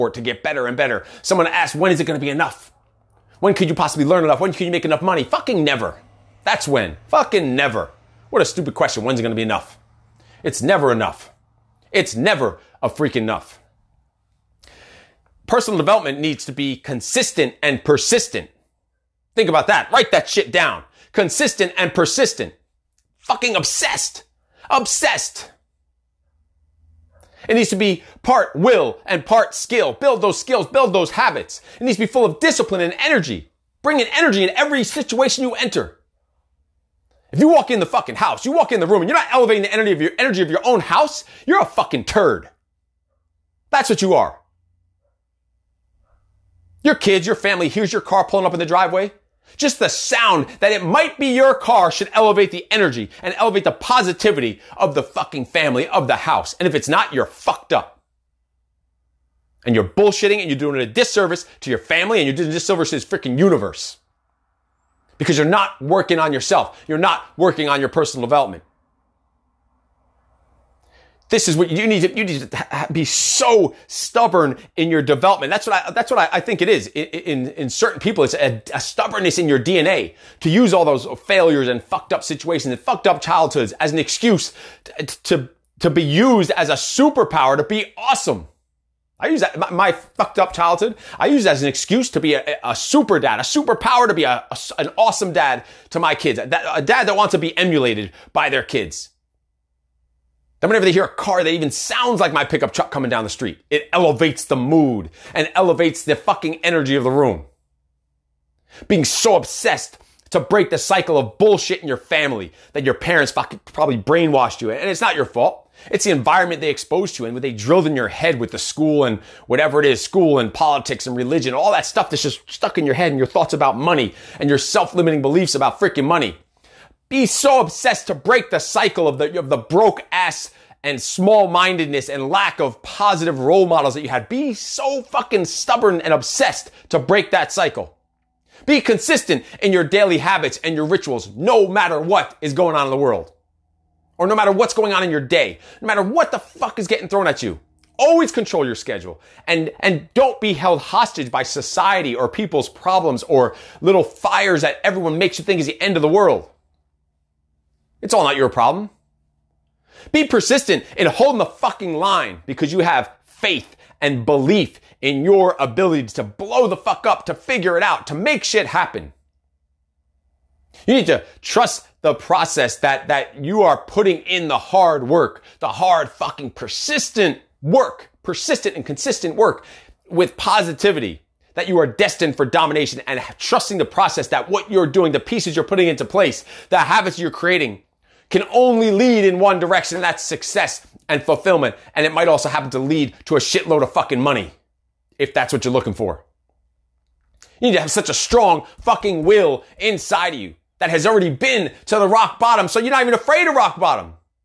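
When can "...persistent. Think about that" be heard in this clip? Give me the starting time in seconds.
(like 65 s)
17 s.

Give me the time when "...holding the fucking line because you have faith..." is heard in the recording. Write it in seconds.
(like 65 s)
161 s.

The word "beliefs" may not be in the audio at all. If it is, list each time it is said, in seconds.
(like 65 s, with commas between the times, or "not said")
125 s, 164 s.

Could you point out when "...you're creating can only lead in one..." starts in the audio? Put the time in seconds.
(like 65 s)
187 s.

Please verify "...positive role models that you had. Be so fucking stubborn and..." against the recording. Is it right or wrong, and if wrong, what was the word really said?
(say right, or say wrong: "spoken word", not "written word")
right.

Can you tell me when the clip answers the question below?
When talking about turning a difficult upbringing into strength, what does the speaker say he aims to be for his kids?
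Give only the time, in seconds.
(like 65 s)
92 s.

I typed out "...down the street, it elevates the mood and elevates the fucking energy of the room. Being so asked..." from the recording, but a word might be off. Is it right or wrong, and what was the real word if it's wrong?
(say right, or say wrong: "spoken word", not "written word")
wrong: "obsessed", not "asked".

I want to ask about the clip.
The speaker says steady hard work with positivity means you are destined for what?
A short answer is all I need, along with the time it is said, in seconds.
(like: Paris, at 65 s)
Domination, at 182 s.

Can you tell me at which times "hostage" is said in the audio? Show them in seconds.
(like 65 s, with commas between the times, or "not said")
150 s.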